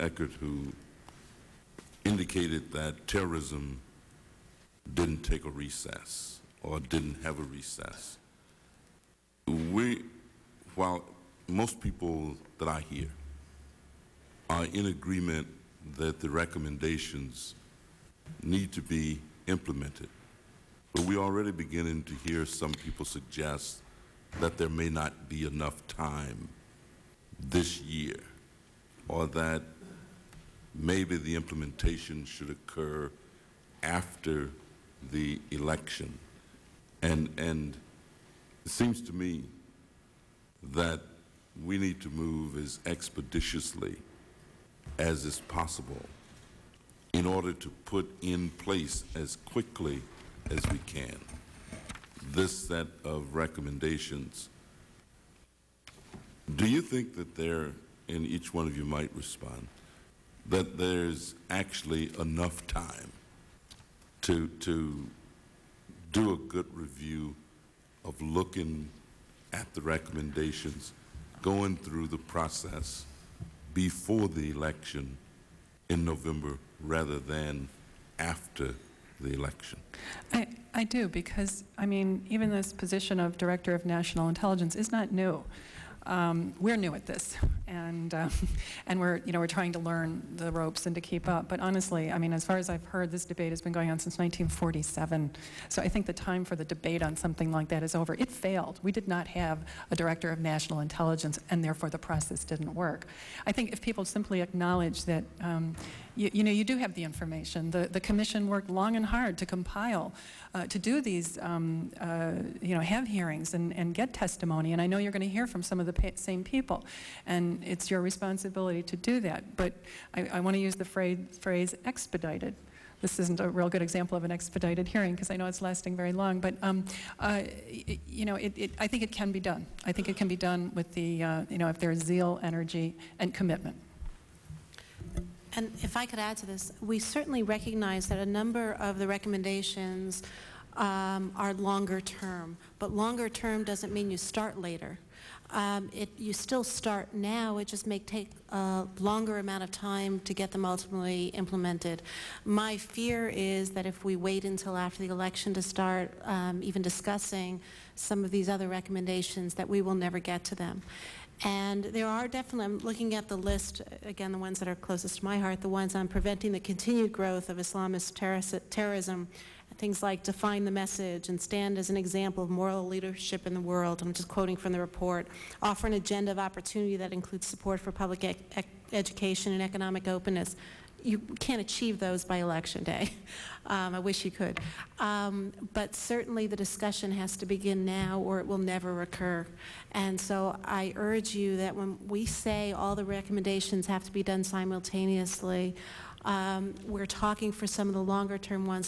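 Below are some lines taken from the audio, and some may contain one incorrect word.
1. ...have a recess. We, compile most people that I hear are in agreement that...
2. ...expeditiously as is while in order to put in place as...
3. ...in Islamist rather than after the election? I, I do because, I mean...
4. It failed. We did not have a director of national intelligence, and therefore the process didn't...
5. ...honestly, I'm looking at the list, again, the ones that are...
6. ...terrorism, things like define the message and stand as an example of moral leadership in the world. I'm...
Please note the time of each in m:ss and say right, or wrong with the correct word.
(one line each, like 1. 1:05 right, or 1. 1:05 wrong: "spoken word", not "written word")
1. 0:07 wrong: "while", not "compile"
2. 0:42 wrong: "possible", not "while"
3. 1:15 wrong: "November", not "Islamist"
4. 1:38 right
5. 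2:42 wrong: "definitely", not "honestly"
6. 2:48 right.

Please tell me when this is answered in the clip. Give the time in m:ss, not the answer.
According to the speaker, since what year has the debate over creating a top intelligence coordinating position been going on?
1:34.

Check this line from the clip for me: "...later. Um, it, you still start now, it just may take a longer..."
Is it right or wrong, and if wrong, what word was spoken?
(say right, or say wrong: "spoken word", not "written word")
right.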